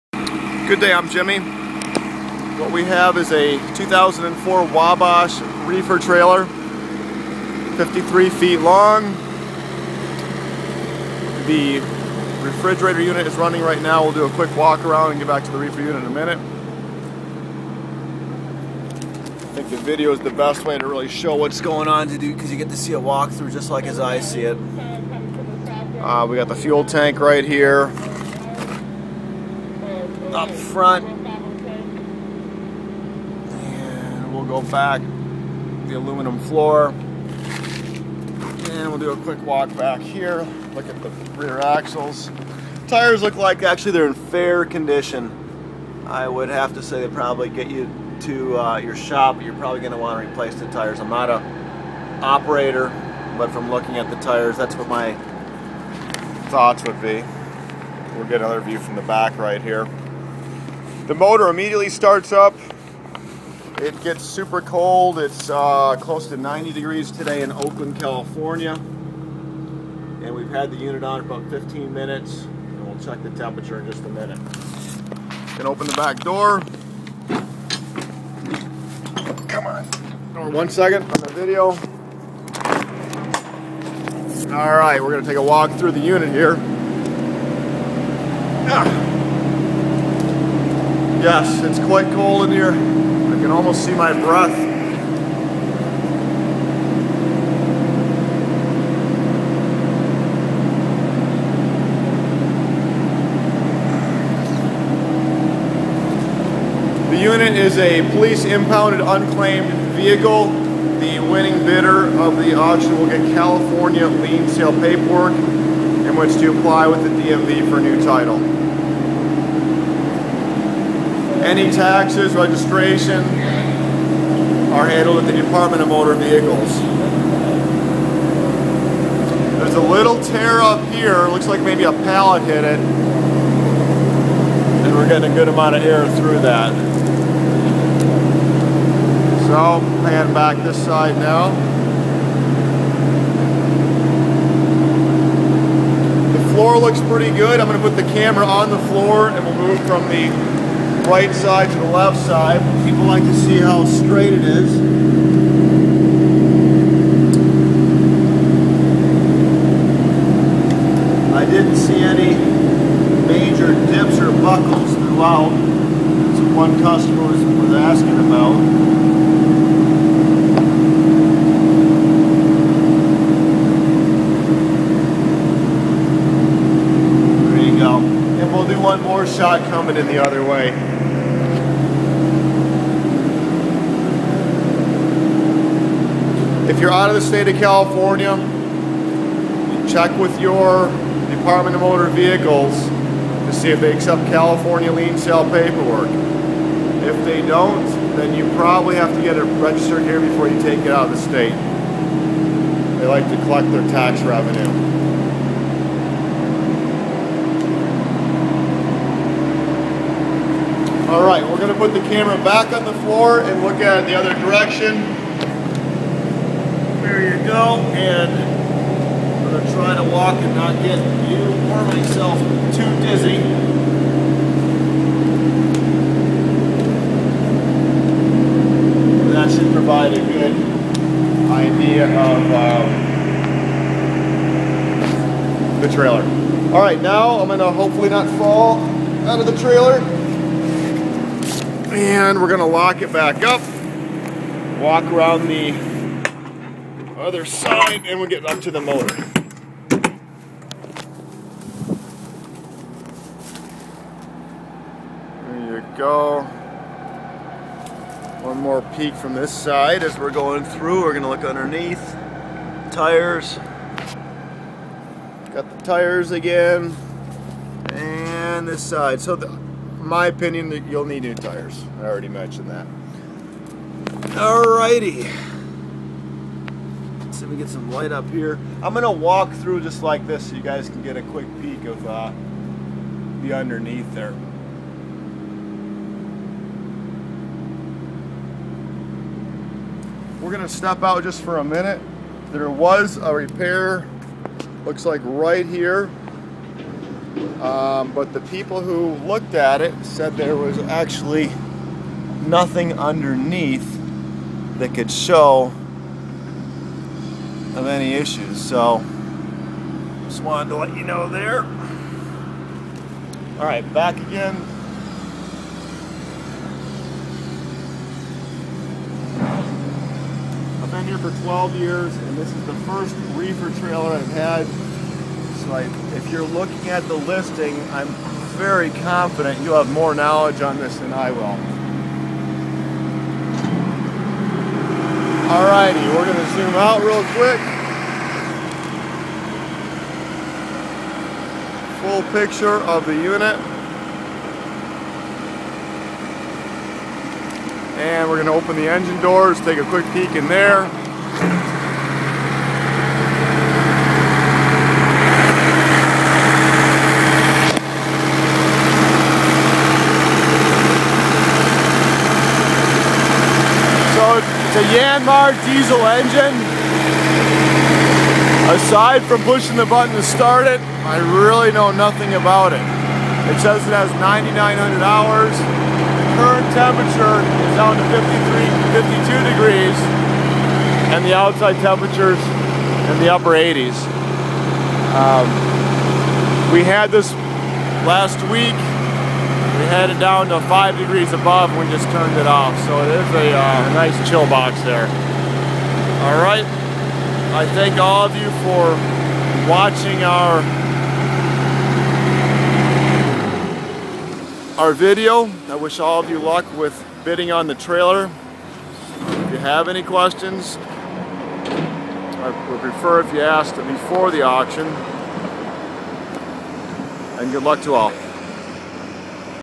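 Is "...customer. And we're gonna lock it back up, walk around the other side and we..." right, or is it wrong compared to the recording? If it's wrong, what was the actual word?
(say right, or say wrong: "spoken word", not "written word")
wrong: "trailer", not "customer".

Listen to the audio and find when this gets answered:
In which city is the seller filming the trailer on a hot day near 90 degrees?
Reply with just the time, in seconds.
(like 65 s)
67 s.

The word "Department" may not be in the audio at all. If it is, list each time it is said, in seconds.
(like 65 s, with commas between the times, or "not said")
125 s, 191 s.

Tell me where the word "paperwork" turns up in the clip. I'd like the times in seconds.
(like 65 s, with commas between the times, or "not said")
114 s, 195 s.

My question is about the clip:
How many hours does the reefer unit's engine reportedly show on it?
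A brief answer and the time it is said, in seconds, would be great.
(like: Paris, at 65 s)
9,900 hours, at 374 s.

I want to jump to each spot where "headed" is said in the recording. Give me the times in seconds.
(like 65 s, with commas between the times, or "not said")
389 s.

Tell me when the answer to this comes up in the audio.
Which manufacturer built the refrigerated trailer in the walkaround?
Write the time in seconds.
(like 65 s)
4 s.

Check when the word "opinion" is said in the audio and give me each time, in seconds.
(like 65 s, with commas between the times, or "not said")
270 s.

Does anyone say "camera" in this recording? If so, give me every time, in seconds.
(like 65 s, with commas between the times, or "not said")
148 s, 212 s.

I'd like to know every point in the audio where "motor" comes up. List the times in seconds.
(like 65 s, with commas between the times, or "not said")
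61 s, 125 s, 191 s, 248 s.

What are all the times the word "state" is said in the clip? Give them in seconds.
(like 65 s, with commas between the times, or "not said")
187 s, 201 s.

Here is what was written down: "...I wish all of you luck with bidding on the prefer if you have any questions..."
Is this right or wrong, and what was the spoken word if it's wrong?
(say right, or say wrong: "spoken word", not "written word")
wrong: "trailer", not "prefer".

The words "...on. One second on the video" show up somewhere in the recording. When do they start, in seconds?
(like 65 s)
79 s.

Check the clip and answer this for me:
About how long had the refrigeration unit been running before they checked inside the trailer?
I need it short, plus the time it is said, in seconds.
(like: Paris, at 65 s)
15 minutes, at 71 s.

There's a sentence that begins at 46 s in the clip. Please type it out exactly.
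I would have to say they probably get you to uh, your shop.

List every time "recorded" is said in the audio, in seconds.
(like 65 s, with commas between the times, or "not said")
not said.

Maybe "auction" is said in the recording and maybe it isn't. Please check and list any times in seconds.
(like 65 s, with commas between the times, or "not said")
112 s, 414 s.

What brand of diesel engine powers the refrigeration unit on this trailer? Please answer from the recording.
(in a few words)
Yanmar.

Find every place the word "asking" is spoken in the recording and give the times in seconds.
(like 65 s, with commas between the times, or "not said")
167 s.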